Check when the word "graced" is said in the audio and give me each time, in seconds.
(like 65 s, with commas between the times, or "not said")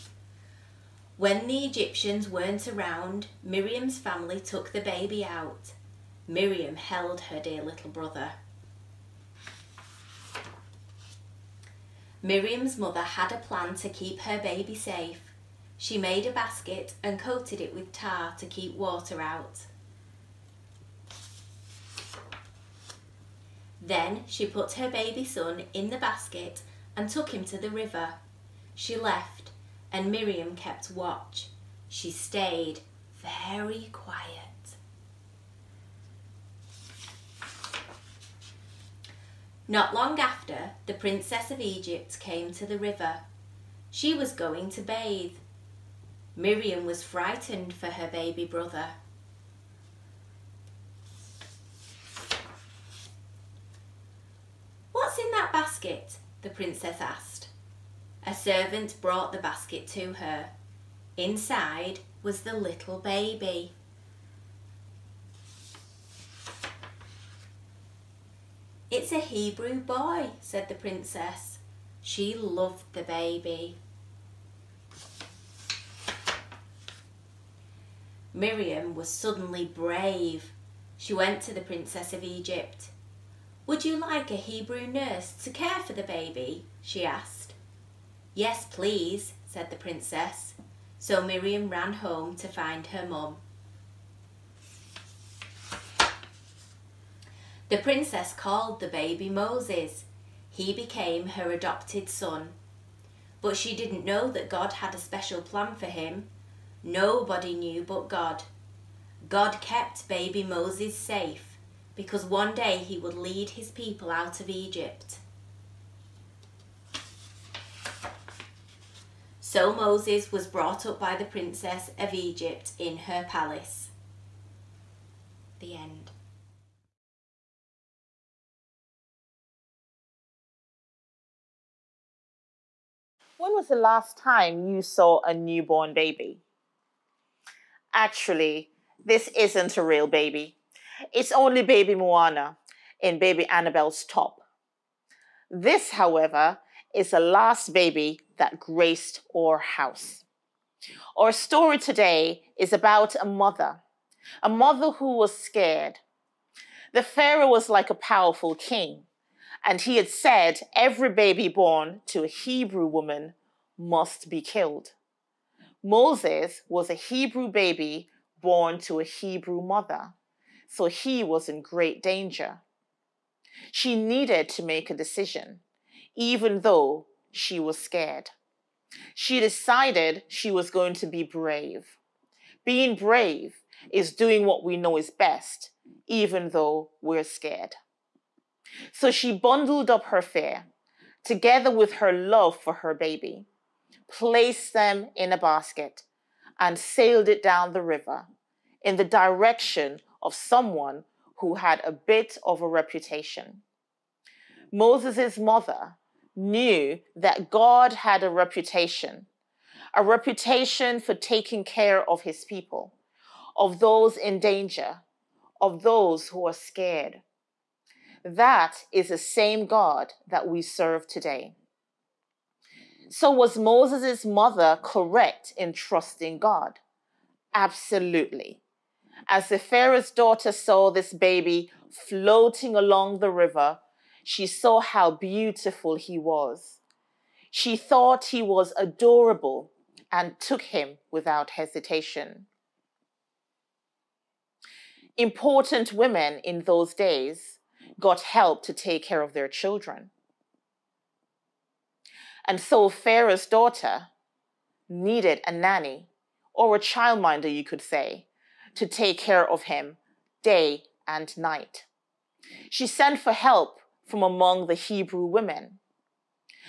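148 s.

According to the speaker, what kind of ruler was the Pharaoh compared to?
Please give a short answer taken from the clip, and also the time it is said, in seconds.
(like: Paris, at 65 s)
A powerful king, at 157 s.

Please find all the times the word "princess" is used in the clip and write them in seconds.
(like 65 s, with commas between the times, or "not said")
40 s, 56 s, 70 s, 81 s, 89 s, 97 s, 121 s.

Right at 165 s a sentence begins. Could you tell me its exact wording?
Moses was a Hebrew baby born to a Hebrew mother, so he was in great danger.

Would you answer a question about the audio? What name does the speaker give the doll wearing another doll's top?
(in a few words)
Baby Moana.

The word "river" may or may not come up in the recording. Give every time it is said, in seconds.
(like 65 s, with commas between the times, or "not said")
27 s, 42 s, 197 s, 233 s.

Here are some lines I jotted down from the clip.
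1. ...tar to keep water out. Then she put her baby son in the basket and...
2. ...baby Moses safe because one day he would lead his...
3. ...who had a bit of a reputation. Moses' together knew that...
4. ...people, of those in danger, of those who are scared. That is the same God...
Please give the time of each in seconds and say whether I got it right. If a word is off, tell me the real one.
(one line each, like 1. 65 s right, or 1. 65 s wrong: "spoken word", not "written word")
1. 17 s right
2. 110 s right
3. 201 s wrong: "mother", not "together"
4. 212 s right.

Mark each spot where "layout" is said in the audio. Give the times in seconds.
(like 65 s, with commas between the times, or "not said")
not said.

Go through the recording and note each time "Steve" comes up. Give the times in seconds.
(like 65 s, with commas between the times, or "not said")
not said.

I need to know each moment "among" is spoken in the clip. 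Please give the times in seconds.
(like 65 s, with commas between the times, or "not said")
264 s.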